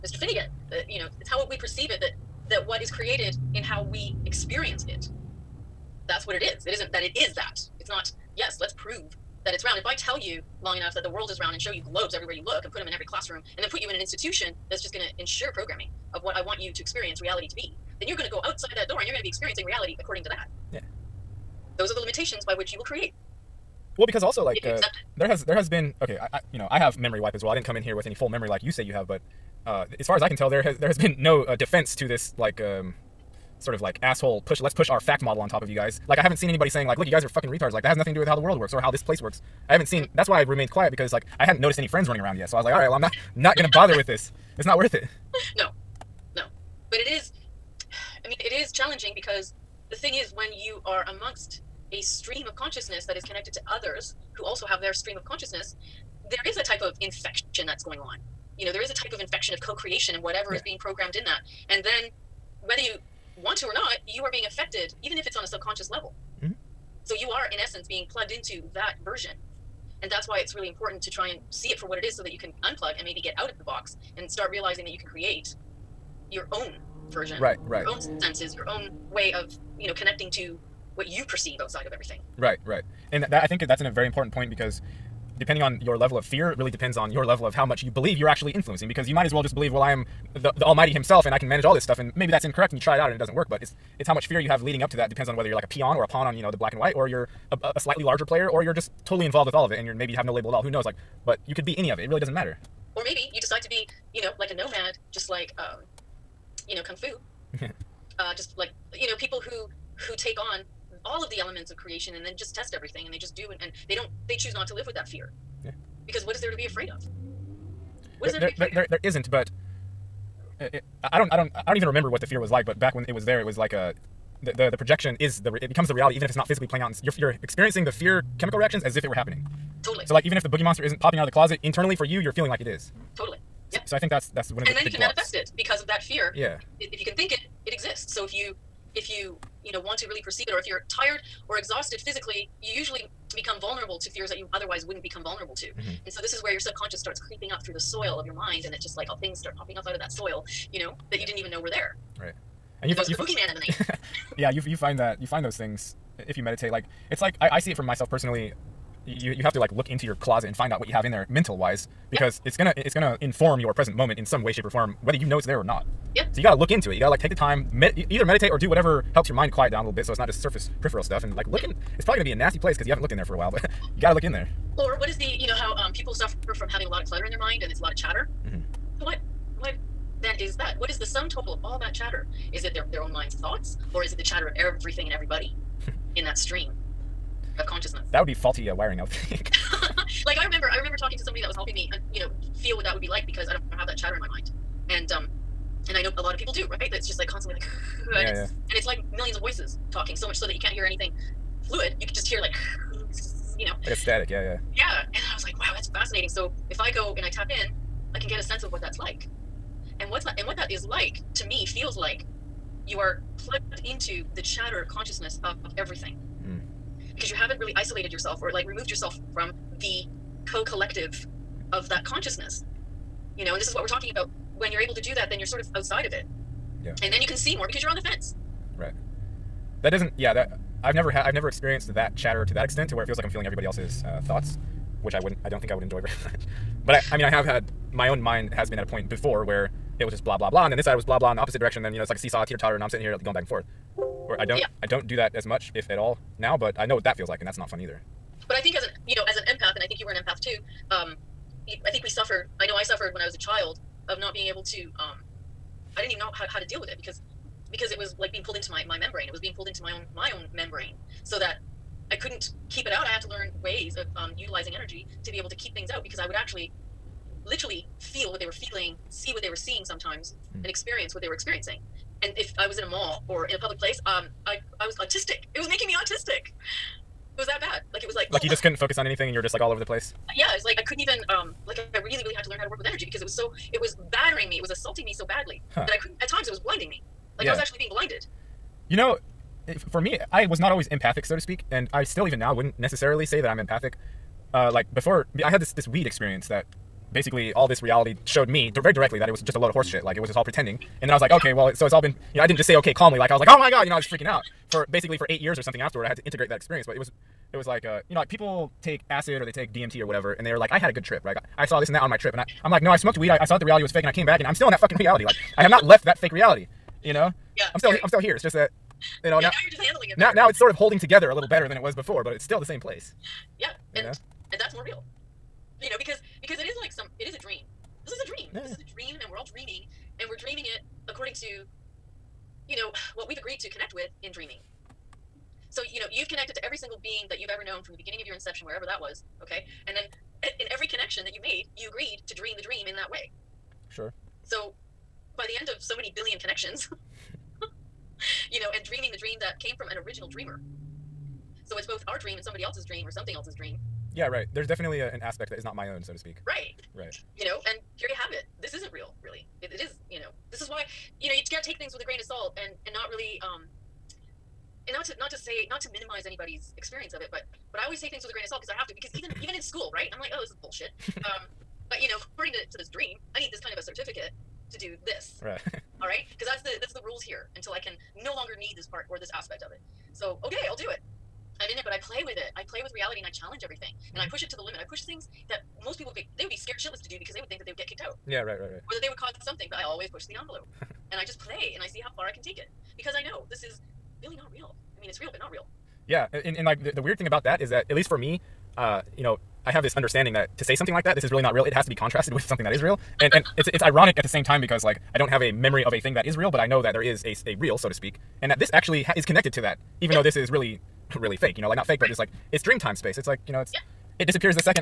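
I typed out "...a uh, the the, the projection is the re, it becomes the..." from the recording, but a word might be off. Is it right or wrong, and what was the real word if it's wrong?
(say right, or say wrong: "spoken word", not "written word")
right.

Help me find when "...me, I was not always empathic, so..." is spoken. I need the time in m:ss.
4:50.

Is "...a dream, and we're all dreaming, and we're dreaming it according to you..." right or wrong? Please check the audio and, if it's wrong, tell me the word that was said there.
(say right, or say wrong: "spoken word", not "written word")
right.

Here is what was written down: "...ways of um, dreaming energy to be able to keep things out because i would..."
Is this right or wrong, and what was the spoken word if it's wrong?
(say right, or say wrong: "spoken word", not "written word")
wrong: "utilizing", not "dreaming".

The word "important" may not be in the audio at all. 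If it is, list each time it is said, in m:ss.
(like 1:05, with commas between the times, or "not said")
1:10, 1:24.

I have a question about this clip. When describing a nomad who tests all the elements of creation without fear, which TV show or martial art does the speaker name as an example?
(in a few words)
Kung Fu.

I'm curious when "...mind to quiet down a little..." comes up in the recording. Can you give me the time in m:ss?
2:49.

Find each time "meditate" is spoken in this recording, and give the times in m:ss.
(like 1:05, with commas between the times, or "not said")
2:36, 2:48.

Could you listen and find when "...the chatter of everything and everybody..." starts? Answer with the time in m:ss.
3:04.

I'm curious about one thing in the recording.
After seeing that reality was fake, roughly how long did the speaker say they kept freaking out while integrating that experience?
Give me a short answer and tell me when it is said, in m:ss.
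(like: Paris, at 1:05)
8 years, at 5:05.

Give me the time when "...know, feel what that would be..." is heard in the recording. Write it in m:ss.
3:12.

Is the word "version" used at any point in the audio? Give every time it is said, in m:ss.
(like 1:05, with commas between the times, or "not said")
1:09, 1:17.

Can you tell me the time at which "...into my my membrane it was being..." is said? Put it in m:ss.
4:18.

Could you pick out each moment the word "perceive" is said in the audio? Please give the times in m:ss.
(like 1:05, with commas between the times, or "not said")
0:01, 1:21, 2:20.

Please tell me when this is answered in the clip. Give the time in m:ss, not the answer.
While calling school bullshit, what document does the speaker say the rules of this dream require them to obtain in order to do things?
6:13.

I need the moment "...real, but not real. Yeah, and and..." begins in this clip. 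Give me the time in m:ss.
6:35.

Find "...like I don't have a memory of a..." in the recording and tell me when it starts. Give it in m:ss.
6:44.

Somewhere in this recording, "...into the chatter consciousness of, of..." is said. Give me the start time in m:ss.
3:33.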